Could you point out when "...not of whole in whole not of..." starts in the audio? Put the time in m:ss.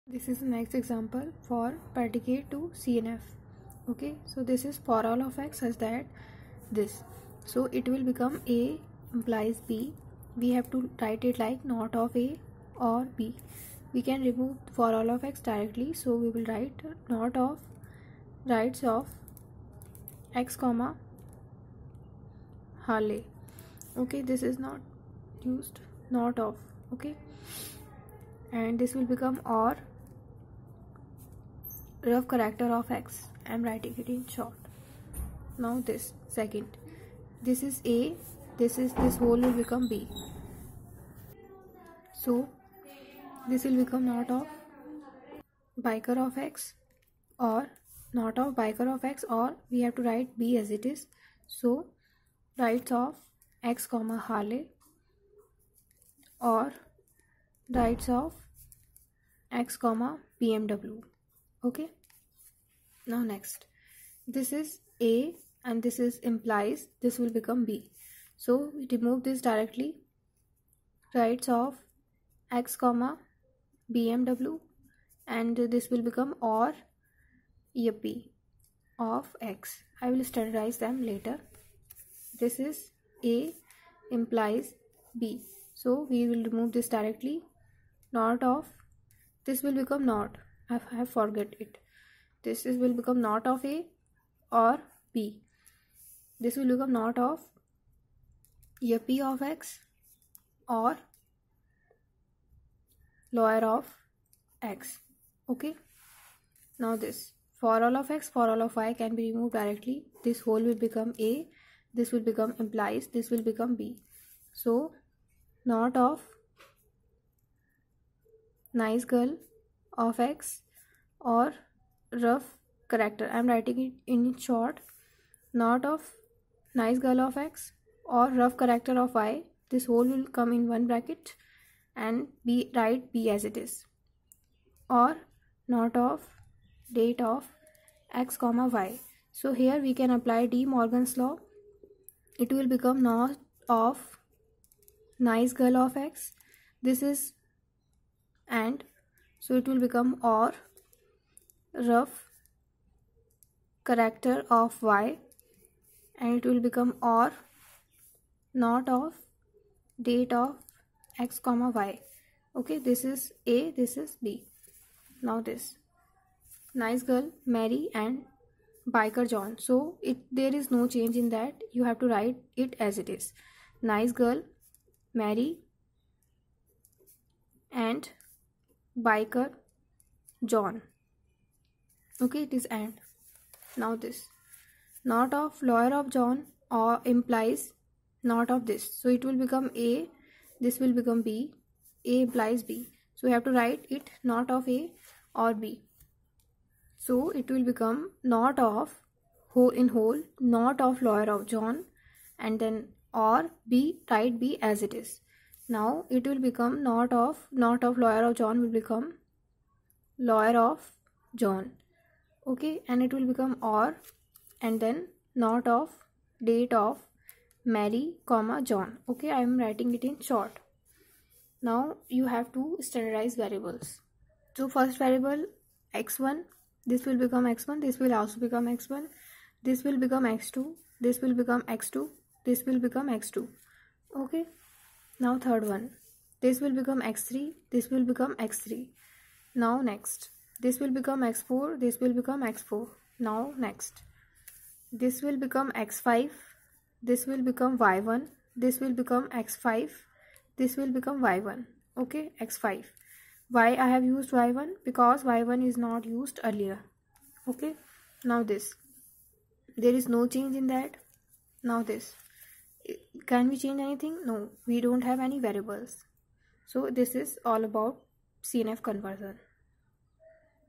3:18.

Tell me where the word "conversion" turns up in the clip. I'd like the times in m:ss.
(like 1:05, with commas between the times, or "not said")
4:28.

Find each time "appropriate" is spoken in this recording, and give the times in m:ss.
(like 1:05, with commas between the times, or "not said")
not said.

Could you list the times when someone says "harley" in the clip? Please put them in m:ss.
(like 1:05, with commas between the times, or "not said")
0:22, 0:54.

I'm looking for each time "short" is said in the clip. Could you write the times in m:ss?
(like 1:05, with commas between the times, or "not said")
0:34, 2:04, 3:40.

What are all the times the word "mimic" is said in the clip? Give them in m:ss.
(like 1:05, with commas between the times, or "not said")
not said.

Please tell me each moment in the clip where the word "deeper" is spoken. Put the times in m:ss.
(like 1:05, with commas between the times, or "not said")
not said.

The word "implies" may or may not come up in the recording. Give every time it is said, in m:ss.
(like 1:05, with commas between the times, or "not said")
0:09, 1:06, 1:24, 1:52, 3:07, 3:12.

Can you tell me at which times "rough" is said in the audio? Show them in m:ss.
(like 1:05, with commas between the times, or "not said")
0:32, 2:02, 2:08, 2:31.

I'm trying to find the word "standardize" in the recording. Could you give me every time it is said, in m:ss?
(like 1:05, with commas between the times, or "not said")
1:20, 3:42.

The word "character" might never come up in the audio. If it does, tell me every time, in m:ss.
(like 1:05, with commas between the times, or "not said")
0:32, 2:02, 2:08, 2:33.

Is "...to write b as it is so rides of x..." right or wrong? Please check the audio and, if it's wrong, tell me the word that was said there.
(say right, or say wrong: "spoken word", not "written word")
right.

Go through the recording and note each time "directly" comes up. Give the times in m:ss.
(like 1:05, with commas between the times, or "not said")
0:15, 1:09, 1:26, 1:49.